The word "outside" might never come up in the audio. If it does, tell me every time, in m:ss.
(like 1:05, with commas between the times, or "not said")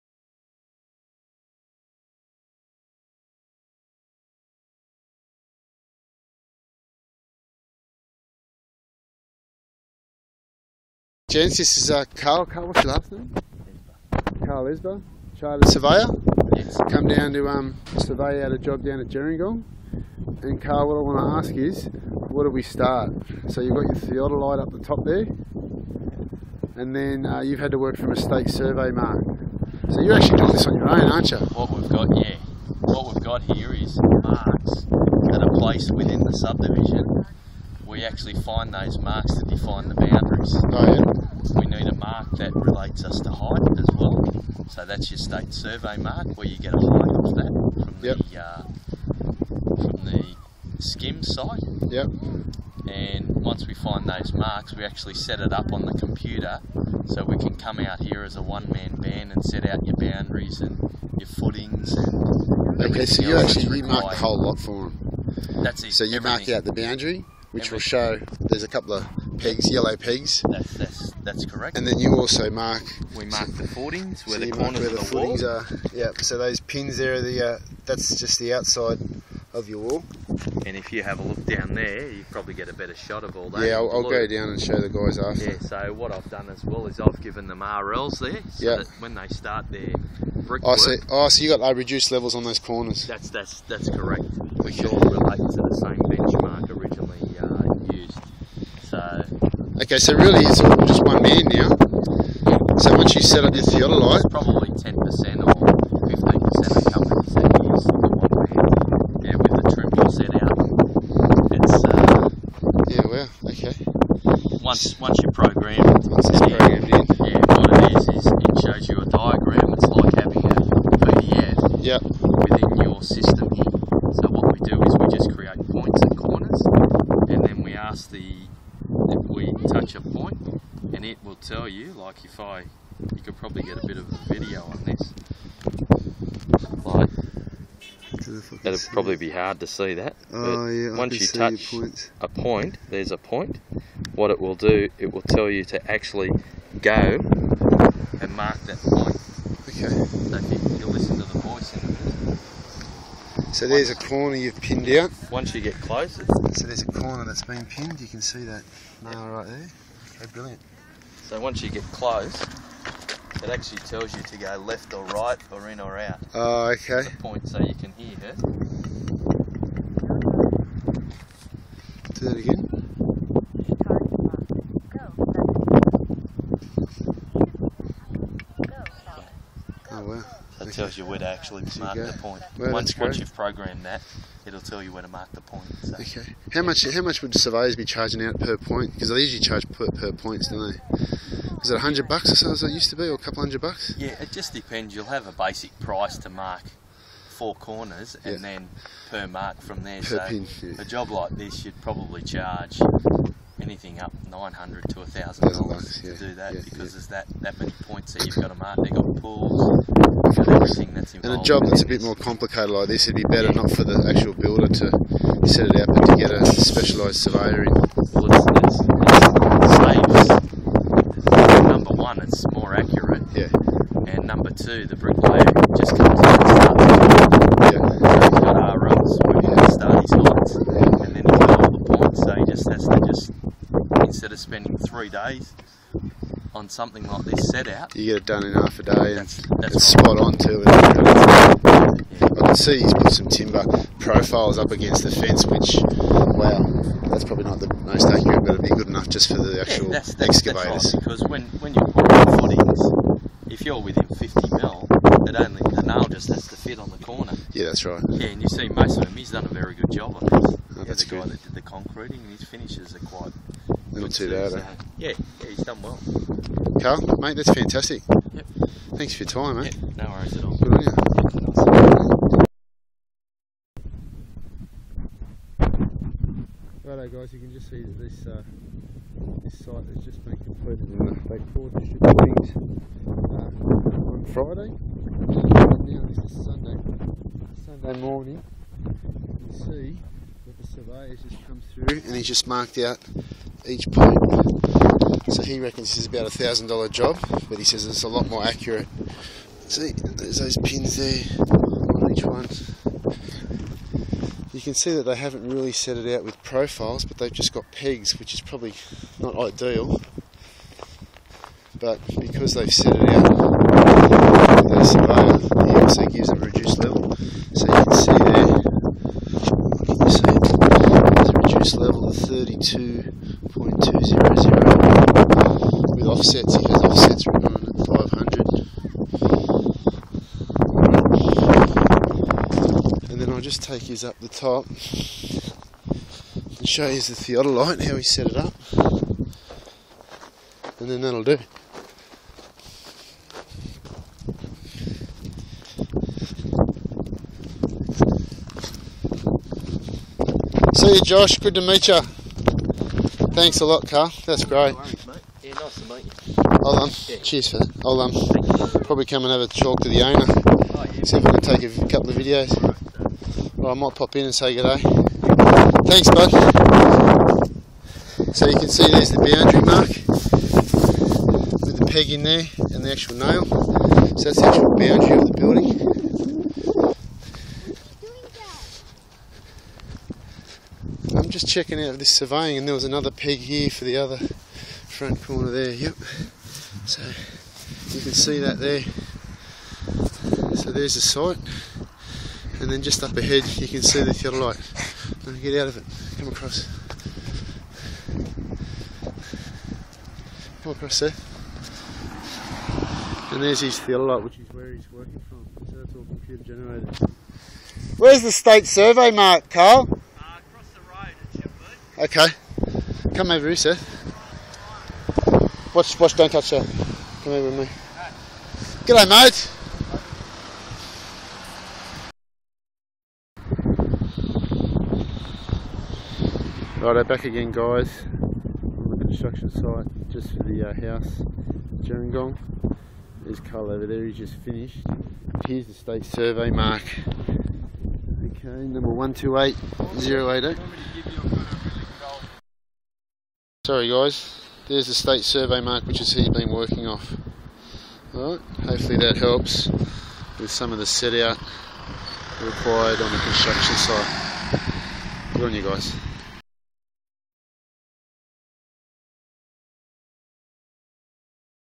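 1:18.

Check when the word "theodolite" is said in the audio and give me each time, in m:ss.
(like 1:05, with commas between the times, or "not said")
0:24, 1:43, 5:37, 6:34, 6:43.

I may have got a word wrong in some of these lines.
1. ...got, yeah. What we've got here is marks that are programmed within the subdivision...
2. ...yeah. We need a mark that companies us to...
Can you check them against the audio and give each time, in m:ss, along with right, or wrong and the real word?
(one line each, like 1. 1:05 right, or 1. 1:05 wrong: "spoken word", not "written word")
1. 0:31 wrong: "placed", not "programmed"
2. 0:40 wrong: "relates", not "companies".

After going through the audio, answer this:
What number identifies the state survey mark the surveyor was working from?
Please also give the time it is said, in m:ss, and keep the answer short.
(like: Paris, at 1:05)
128088, at 7:18.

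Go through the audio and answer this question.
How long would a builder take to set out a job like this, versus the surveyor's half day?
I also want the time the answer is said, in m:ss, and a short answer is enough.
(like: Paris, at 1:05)
3 days, at 3:54.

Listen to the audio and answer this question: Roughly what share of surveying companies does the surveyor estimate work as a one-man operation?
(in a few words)
10% or 15%.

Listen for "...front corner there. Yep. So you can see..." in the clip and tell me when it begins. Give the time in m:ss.
6:24.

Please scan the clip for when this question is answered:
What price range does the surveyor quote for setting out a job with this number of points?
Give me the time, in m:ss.
3:24.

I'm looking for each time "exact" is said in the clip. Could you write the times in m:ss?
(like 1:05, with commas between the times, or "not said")
not said.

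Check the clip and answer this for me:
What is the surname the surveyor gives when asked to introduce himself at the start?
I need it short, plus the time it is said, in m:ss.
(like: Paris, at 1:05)
Isba, at 0:14.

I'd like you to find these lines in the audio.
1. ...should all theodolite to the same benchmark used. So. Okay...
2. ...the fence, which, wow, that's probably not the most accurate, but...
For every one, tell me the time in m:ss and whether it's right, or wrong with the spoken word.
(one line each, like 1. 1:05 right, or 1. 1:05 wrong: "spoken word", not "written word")
1. 1:34 wrong: "relate", not "theodolite"
2. 4:05 right.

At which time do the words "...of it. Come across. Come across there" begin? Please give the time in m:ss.
6:35.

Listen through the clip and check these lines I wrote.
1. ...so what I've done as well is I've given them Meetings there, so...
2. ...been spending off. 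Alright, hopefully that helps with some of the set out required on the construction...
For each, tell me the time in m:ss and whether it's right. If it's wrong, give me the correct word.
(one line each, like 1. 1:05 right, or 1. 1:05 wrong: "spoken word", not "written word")
1. 1:25 wrong: "RLs", not "Meetings"
2. 7:26 wrong: "working", not "spending".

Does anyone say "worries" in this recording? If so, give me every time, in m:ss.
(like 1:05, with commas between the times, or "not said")
4:30, 5:54.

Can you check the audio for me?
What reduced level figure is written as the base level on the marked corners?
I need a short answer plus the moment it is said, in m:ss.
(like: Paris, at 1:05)
32.200, at 5:22.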